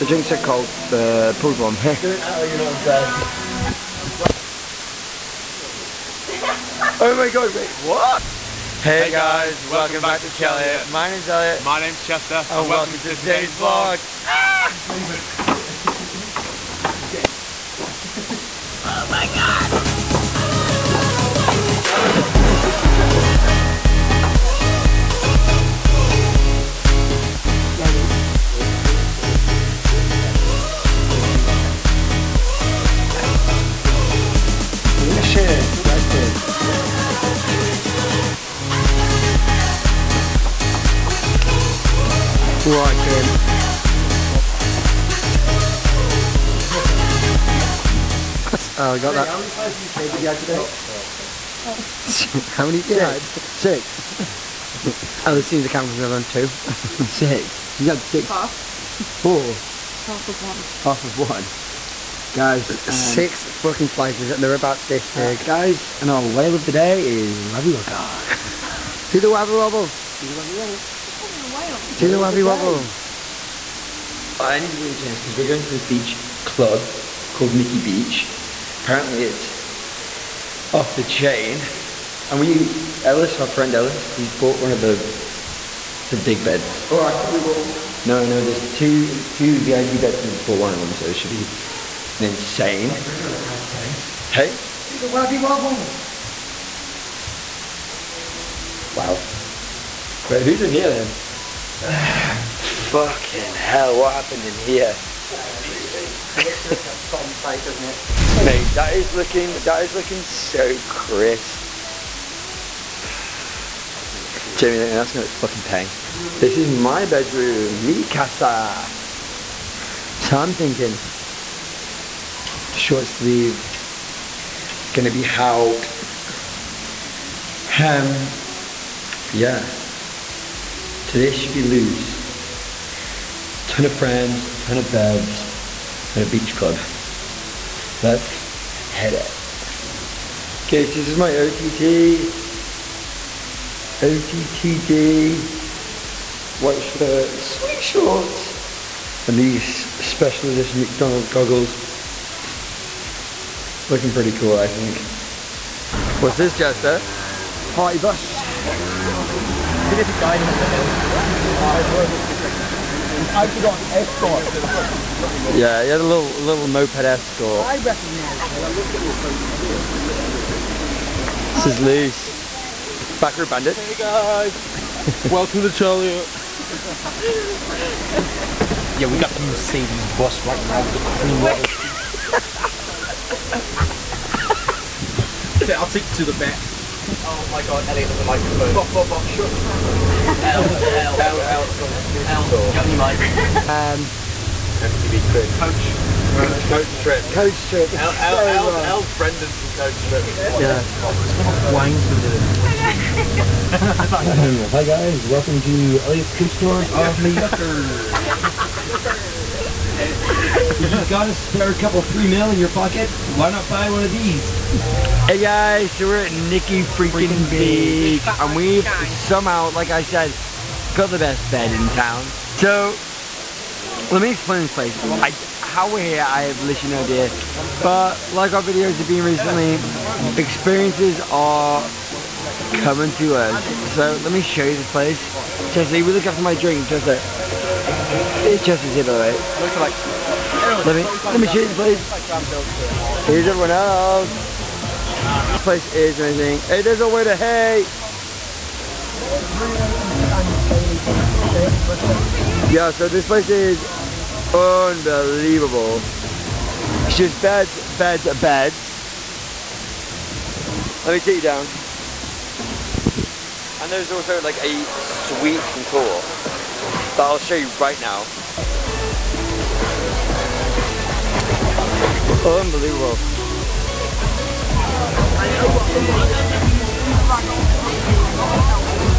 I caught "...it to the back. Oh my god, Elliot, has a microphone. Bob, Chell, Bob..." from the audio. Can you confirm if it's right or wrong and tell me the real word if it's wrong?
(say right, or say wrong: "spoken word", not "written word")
wrong: "Bob", not "Chell".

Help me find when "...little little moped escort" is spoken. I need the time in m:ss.
2:46.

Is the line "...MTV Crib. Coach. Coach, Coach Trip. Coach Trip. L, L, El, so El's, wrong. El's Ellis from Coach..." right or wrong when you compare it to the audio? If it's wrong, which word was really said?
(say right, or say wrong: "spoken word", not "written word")
wrong: "Brendan", not "Ellis".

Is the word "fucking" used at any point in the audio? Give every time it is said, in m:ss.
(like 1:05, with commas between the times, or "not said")
1:03, 1:42, 1:55.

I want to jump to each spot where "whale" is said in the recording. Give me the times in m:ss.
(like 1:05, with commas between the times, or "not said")
1:06, 1:11.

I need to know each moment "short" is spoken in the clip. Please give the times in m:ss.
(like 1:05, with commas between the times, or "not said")
2:02, 2:27.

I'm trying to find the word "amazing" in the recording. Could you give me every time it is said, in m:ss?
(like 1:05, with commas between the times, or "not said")
4:06.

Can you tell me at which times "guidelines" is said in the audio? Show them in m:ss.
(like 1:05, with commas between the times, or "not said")
not said.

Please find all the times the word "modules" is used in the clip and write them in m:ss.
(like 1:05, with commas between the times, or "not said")
not said.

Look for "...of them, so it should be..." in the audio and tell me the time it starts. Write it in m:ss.
1:30.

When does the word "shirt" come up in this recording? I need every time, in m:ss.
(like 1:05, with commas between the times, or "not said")
2:26.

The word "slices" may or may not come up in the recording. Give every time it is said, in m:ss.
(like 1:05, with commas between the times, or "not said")
0:49, 1:03.